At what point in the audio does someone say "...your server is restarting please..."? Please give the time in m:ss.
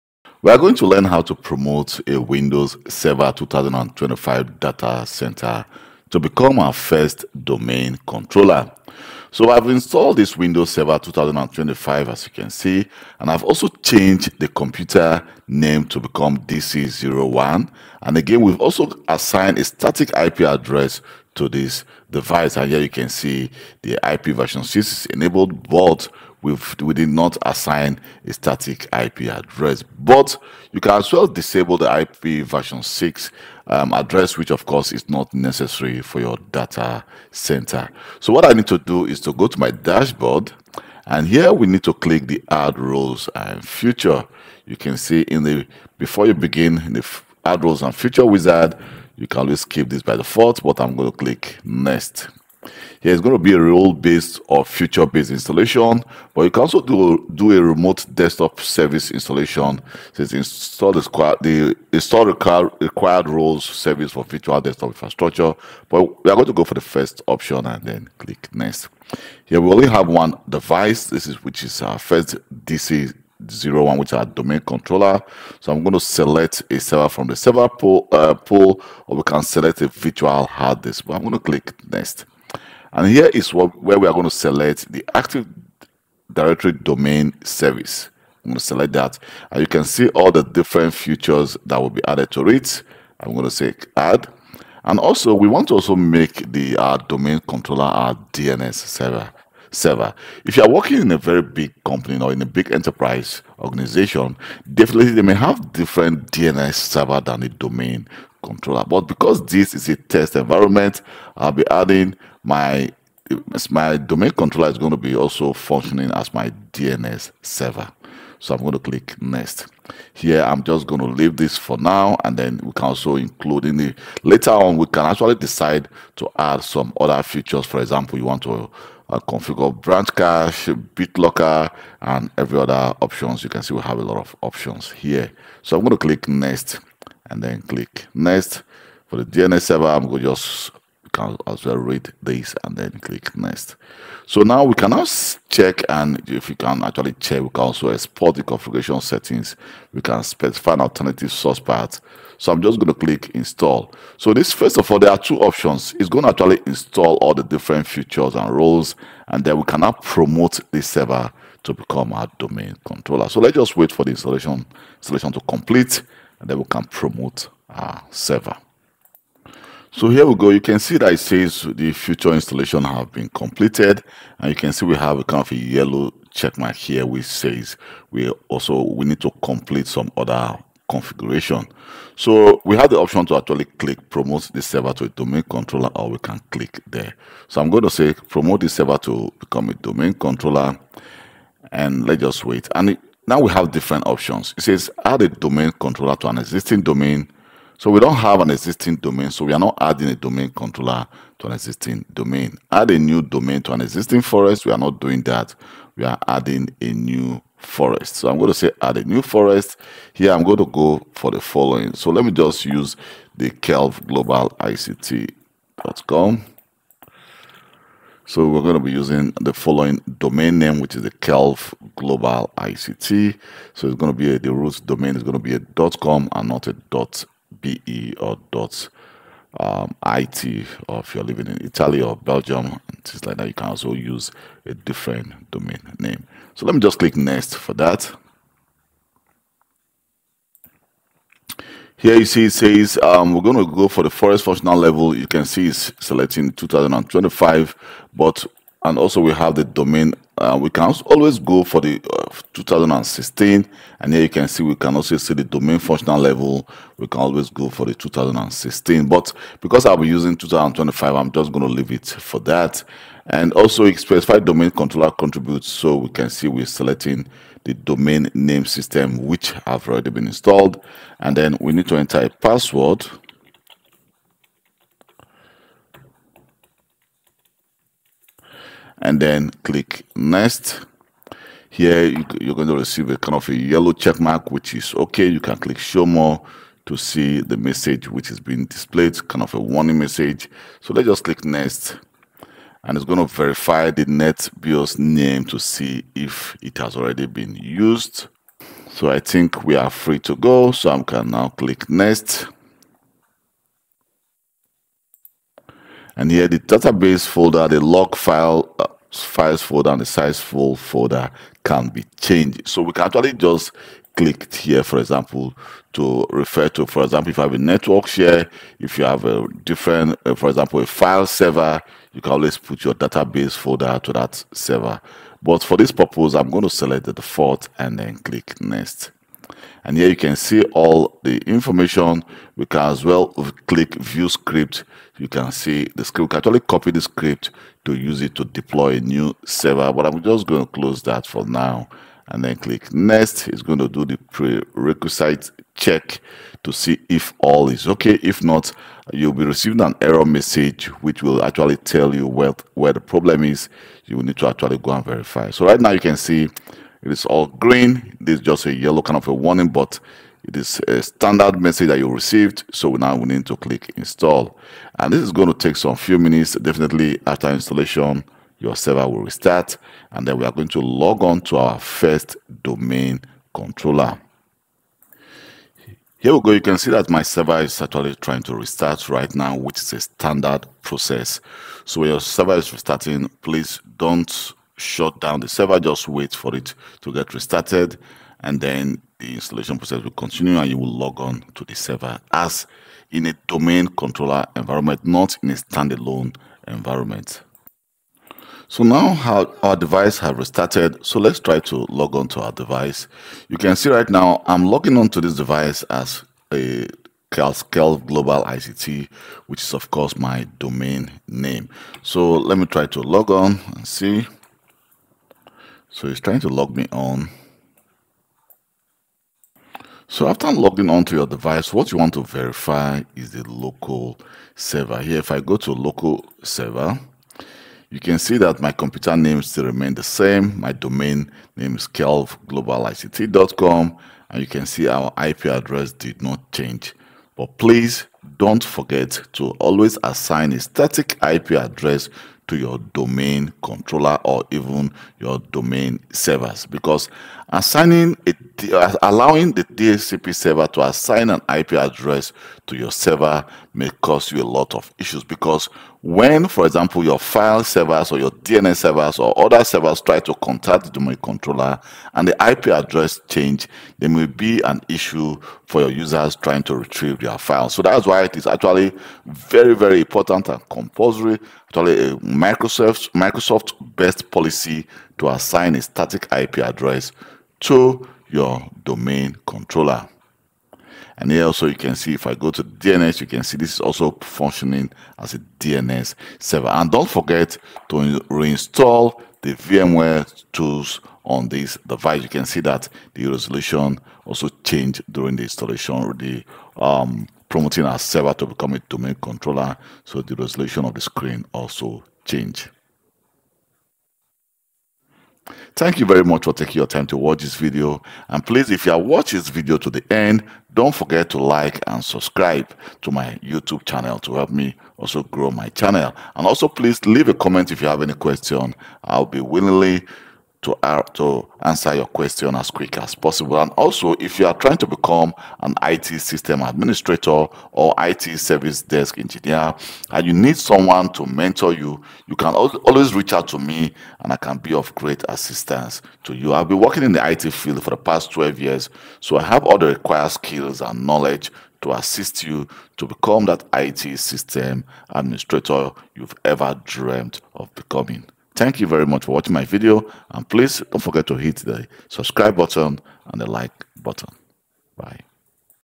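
6:22.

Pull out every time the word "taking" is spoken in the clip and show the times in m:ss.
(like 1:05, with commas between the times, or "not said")
8:26.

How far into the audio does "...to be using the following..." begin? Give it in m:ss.
3:38.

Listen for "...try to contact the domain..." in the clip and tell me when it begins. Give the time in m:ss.
7:39.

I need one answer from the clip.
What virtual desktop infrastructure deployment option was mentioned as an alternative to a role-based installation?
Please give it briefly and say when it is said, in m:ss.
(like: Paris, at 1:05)
Remote desktop service installation, at 0:57.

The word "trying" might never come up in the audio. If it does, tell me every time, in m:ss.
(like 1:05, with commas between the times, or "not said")
6:18, 6:56, 7:46, 8:44.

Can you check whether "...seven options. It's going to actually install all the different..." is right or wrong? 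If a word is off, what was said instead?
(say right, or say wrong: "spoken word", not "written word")
wrong: "two", not "seven".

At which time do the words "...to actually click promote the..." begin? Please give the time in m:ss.
3:03.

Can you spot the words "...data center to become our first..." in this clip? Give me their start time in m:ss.
0:04.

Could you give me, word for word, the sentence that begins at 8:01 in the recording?
And here also you can see if I go to DNS, you can see this is also functioning as a DNS server.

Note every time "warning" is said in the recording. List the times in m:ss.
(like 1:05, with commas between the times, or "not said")
4:49, 5:59.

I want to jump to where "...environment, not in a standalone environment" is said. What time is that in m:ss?
6:34.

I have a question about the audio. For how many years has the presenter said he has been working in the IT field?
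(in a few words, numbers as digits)
12.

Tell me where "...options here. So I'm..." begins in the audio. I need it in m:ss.
2:14.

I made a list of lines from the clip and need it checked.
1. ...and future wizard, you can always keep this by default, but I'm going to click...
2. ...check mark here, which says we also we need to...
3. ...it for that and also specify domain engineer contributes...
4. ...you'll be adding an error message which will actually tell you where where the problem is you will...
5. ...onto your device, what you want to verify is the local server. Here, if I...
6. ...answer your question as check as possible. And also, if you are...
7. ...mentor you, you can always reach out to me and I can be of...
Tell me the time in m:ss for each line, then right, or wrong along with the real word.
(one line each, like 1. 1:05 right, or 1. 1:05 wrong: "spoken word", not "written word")
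1. 0:47 right
2. 2:56 right
3. 4:21 wrong: "controller", not "engineer"
4. 5:49 wrong: "receiving", not "adding"
5. 7:00 right
6. 8:41 wrong: "quick", not "check"
7. 8:51 right.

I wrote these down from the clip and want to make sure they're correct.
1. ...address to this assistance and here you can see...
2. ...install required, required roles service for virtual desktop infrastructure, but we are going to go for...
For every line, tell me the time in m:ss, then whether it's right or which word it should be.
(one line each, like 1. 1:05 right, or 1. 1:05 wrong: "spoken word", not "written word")
1. 0:20 wrong: "device", not "assistance"
2. 1:01 right.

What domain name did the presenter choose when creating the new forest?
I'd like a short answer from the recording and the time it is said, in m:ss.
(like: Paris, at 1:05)
Kelv Global ICT.com, at 3:33.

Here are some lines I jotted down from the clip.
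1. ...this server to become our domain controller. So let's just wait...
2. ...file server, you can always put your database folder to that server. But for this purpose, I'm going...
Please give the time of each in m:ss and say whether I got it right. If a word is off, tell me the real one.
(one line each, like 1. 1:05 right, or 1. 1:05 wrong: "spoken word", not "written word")
1. 2:40 right
2. 5:20 right.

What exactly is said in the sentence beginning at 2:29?
We can specify an alternative source path.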